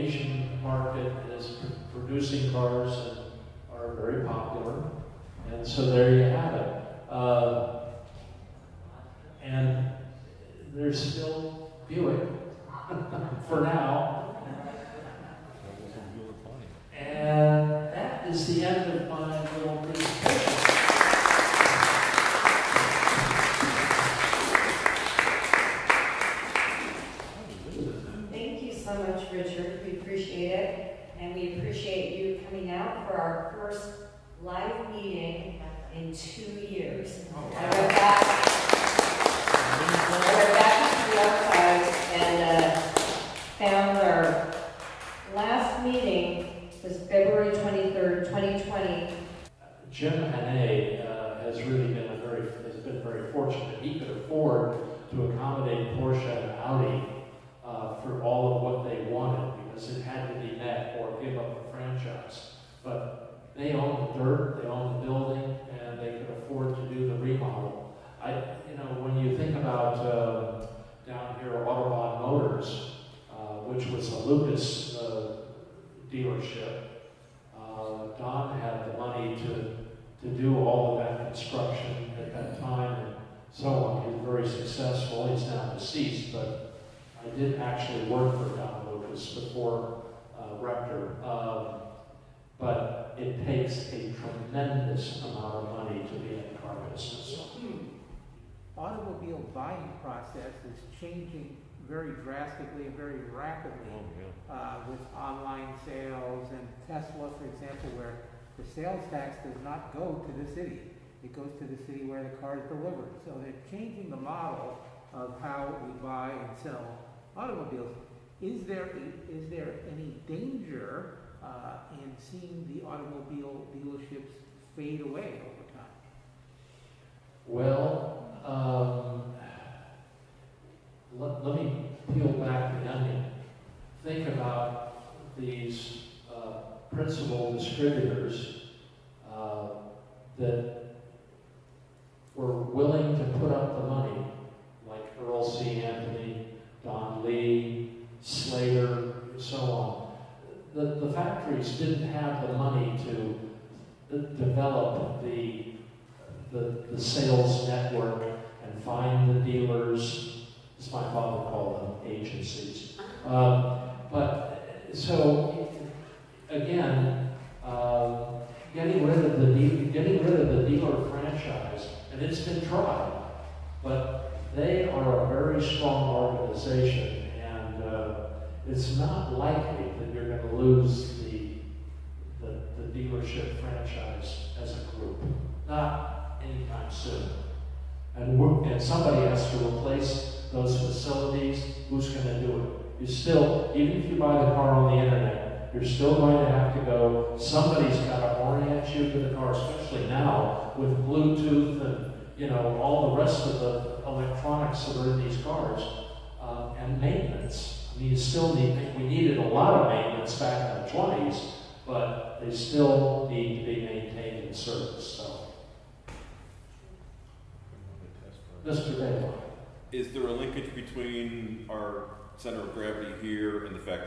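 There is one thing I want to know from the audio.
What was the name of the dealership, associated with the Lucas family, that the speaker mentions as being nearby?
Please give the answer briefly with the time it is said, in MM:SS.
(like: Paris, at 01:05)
Audubon Motors, at 01:11.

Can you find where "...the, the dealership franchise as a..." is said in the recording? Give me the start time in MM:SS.
03:02.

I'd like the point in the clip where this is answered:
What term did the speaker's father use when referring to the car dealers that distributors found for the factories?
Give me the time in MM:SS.
02:42.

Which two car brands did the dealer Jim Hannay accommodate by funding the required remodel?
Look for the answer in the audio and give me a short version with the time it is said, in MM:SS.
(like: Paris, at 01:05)
Porsche and Audi, at 00:55.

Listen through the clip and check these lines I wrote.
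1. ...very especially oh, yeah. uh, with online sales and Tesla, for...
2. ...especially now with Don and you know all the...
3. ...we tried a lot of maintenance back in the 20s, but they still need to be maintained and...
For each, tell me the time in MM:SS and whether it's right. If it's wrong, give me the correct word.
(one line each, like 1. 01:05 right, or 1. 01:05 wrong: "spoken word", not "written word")
1. 01:42 wrong: "rapidly", not "especially"
2. 03:19 wrong: "Bluetooth", not "Don"
3. 03:28 wrong: "needed", not "tried".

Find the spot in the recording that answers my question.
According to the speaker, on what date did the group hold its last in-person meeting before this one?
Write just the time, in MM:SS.
00:47.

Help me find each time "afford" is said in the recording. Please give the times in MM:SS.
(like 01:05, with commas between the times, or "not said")
00:54, 01:06.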